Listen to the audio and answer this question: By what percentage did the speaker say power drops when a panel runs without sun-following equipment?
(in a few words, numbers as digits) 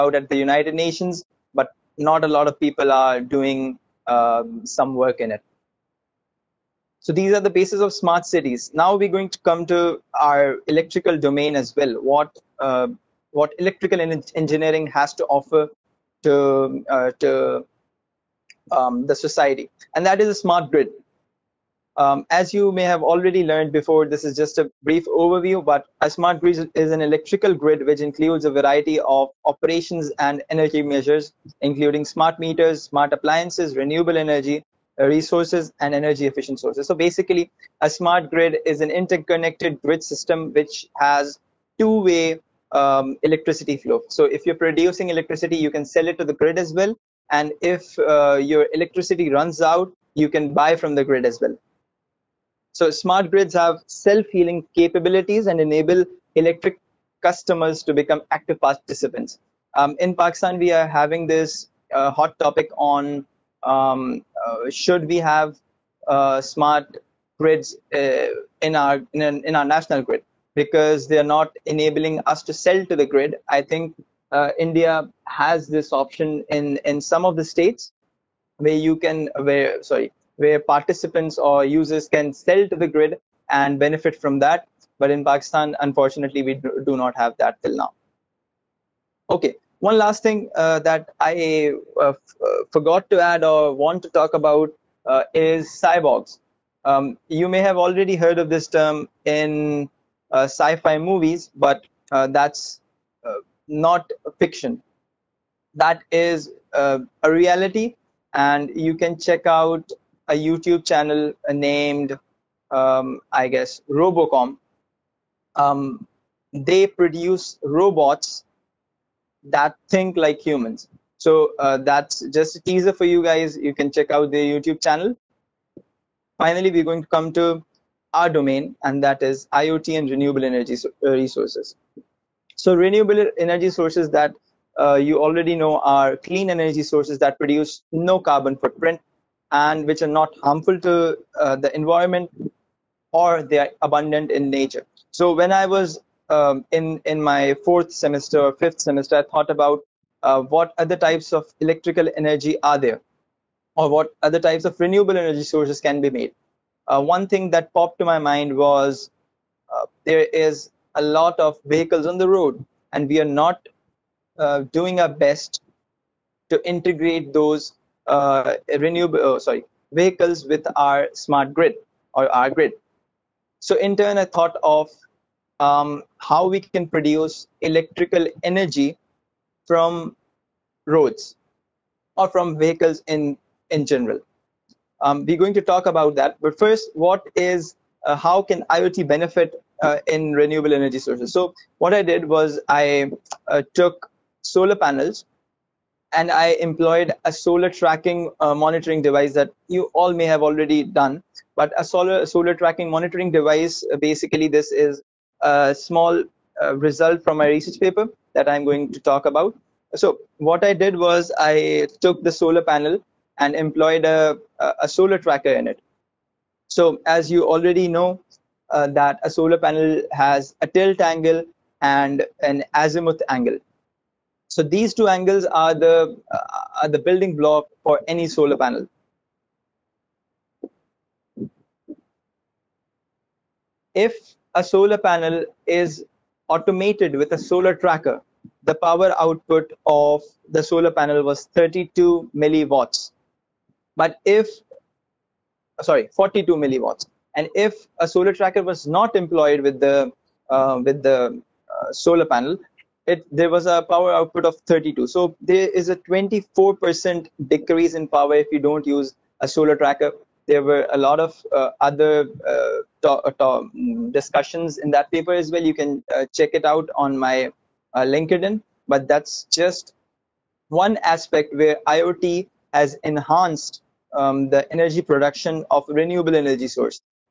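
24%.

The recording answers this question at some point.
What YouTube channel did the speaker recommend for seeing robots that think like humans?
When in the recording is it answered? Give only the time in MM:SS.
01:53.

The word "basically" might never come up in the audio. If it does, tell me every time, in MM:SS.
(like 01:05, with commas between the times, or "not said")
00:36, 03:23.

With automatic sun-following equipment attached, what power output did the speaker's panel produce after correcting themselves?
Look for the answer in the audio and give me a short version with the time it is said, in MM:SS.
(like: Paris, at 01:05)
42 milliwatts, at 04:06.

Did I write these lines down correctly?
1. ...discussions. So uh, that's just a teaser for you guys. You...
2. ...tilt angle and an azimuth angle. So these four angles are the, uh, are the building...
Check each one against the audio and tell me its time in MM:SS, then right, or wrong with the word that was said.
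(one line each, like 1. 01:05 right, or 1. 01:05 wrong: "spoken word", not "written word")
1. 02:00 wrong: "humans", not "discussions"
2. 03:40 wrong: "two", not "four".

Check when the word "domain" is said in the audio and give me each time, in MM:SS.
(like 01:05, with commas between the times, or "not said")
00:11, 02:08.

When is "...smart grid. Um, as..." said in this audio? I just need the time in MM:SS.
00:20.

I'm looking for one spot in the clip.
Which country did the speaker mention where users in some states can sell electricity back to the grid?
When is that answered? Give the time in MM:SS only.
01:14.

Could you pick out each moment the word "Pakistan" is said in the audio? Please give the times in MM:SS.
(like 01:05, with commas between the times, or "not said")
01:00, 01:25.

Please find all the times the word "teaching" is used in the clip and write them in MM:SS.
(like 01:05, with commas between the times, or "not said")
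not said.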